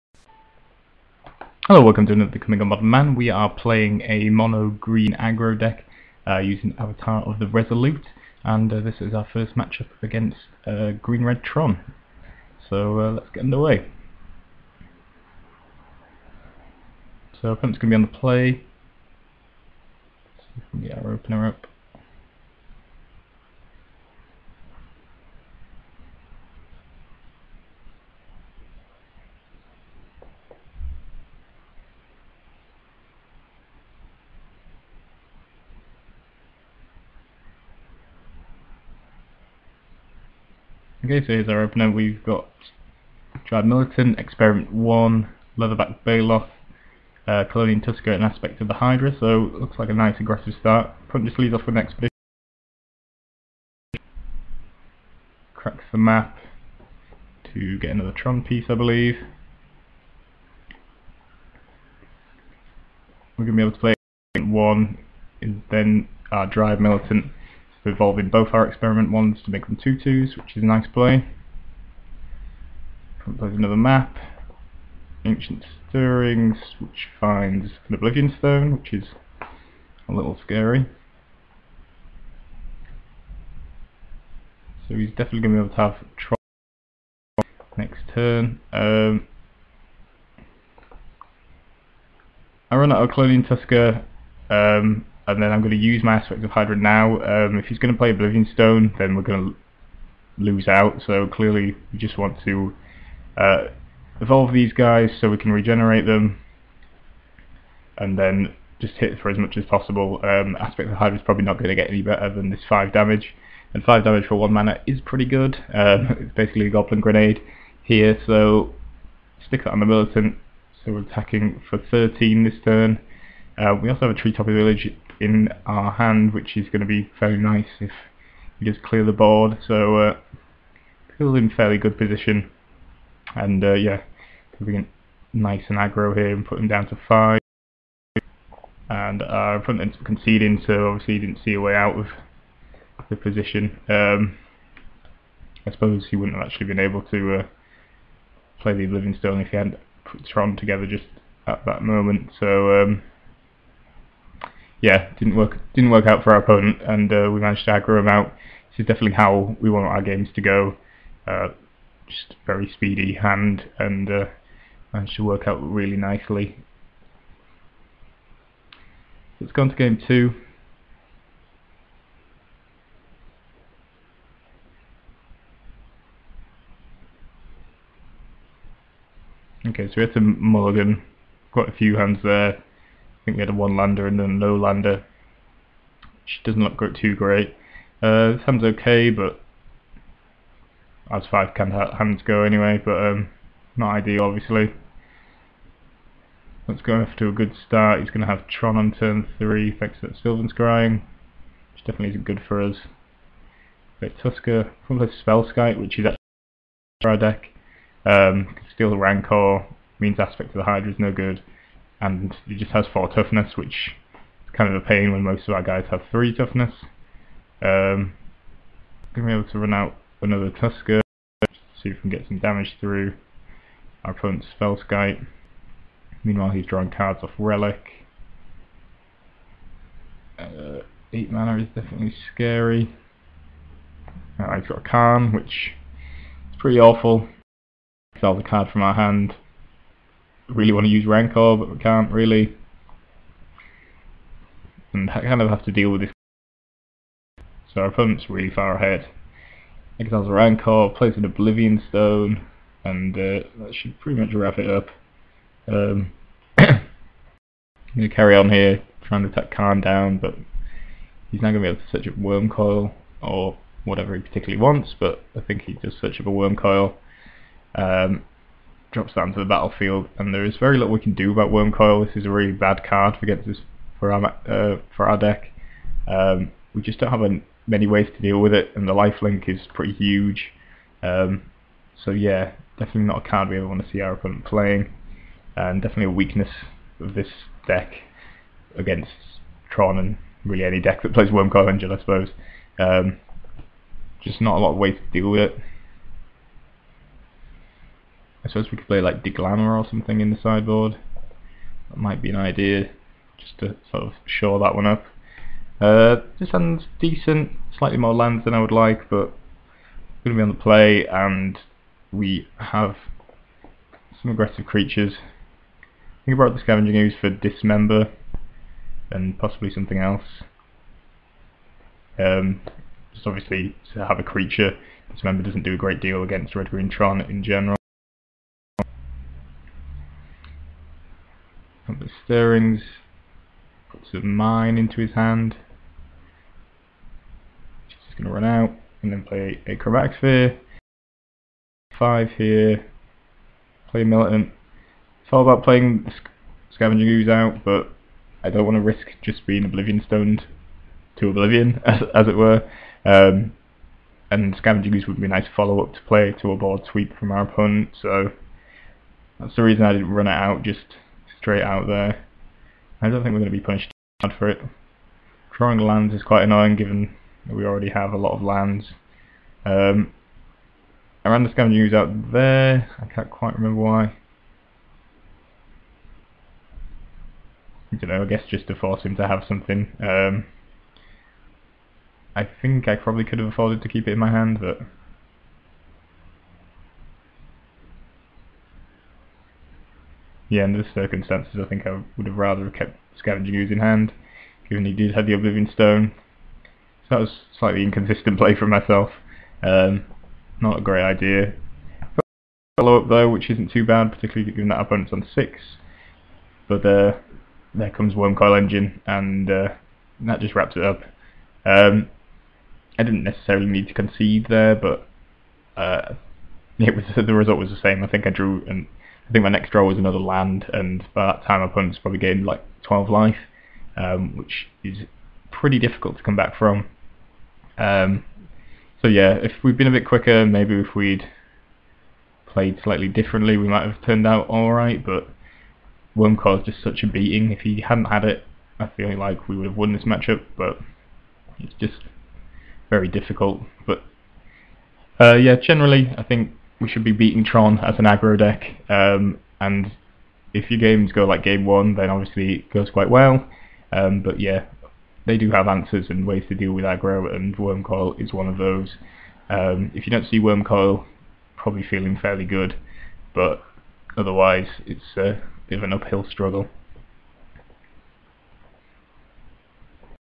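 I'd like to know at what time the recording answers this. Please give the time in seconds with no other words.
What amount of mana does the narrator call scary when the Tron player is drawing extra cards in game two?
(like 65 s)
231 s.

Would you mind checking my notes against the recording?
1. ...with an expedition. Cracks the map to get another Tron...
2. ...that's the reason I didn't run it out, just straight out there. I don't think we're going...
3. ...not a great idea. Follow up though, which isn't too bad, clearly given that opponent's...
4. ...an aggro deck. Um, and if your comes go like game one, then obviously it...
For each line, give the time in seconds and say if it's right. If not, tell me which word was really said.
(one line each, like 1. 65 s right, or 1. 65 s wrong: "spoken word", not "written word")
1. 51 s right
2. 359 s right
3. 400 s wrong: "particularly", not "clearly"
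4. 447 s wrong: "games", not "comes".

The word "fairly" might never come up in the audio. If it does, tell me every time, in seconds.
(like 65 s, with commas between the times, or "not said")
131 s, 462 s.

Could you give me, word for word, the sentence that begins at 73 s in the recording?
There's another map, Ancient Stirrings, which finds an Oblivion Stone, which is a little scary.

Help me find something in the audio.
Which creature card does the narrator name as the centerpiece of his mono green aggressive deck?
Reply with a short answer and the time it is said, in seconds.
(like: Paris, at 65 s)
Avatar of the Resolute, at 6 s.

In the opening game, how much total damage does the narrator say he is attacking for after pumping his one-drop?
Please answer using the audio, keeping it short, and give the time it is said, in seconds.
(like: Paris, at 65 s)
13, at 121 s.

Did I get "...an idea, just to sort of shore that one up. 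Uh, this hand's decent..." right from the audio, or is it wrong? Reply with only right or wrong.
right.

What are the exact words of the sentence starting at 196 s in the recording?
Let's go off to a good start.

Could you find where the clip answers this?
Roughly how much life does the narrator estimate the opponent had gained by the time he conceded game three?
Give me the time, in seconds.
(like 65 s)
422 s.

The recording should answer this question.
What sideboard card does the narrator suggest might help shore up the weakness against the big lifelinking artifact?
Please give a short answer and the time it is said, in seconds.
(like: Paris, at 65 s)
Deglamer, at 299 s.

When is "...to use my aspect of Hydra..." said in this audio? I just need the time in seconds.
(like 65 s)
95 s.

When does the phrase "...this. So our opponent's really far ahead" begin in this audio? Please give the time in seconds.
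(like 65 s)
246 s.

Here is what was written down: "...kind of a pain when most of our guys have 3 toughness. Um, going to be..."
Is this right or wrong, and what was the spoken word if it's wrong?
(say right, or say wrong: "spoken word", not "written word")
right.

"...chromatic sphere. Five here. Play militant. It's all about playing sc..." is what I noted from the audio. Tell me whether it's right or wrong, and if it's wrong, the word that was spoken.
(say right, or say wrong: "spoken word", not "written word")
right.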